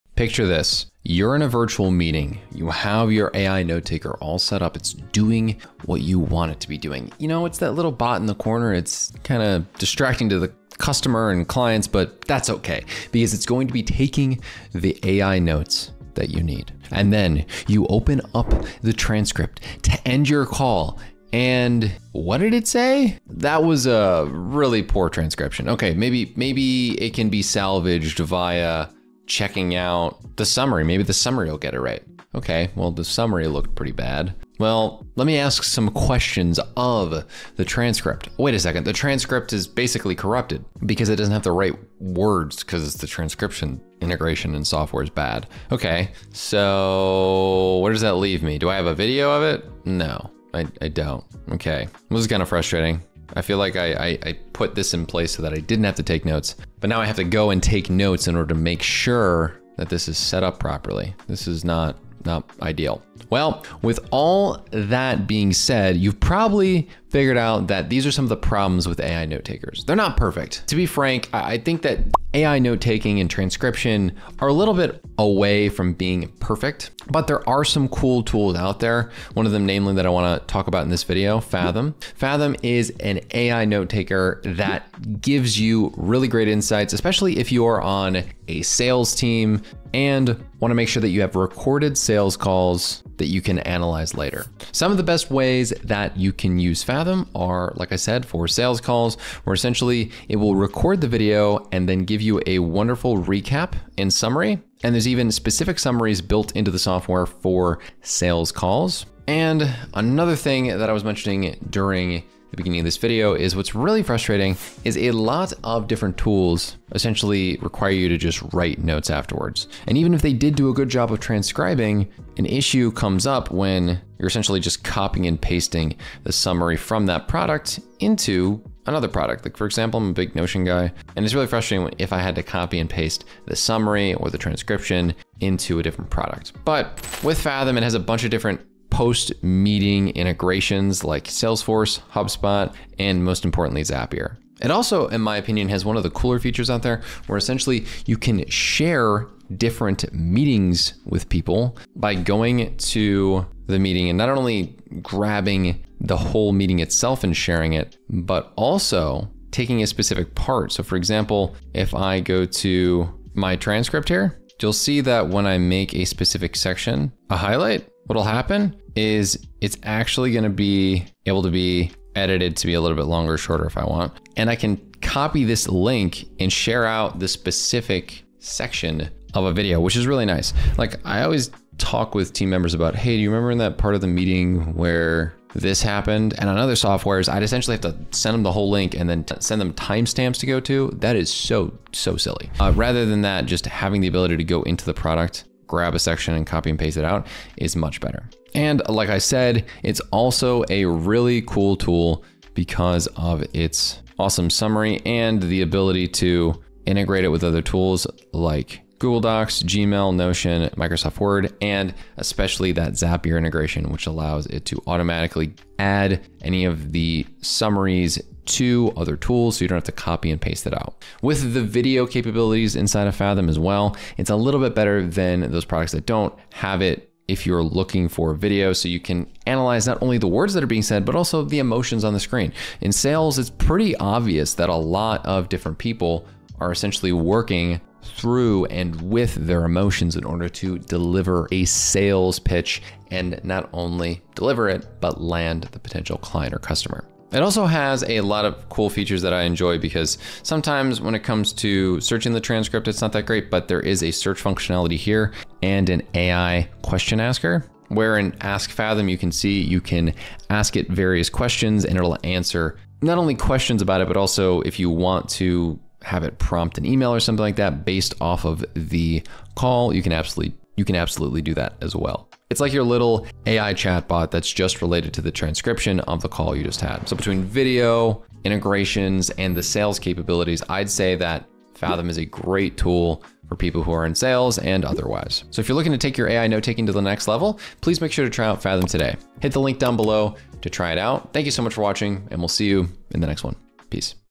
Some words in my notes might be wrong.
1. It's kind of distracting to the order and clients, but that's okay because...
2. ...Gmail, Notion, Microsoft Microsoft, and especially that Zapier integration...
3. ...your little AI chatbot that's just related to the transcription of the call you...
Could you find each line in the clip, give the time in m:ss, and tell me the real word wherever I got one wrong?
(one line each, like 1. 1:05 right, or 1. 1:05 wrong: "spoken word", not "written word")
1. 0:08 wrong: "customer", not "order"
2. 3:29 wrong: "Word", not "Microsoft"
3. 4:32 right.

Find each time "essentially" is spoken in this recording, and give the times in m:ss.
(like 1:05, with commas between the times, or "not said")
1:39, 1:56, 2:04, 2:27, 3:07, 3:56.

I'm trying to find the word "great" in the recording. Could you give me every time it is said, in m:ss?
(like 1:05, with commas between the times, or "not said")
1:26, 4:13, 4:42.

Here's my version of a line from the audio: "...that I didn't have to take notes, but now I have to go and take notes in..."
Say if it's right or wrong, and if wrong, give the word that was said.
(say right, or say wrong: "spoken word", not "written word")
right.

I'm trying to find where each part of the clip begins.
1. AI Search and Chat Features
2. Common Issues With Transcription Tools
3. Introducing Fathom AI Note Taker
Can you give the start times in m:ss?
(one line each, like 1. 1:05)
1. 3:41
2. 1:04
3. 1:21.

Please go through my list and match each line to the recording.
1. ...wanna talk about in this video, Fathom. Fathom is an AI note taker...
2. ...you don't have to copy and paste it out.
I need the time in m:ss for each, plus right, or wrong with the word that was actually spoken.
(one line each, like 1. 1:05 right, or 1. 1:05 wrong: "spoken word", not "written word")
1. 1:20 right
2. 3:39 right.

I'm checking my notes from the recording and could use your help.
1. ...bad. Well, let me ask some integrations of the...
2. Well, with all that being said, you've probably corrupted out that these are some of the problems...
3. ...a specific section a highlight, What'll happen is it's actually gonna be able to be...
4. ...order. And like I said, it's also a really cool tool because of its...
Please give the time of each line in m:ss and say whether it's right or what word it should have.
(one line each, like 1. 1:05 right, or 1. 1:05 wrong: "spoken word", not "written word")
1. 0:33 wrong: "questions", not "integrations"
2. 1:03 wrong: "figured", not "corrupted"
3. 2:45 right
4. 3:18 wrong: "better", not "order".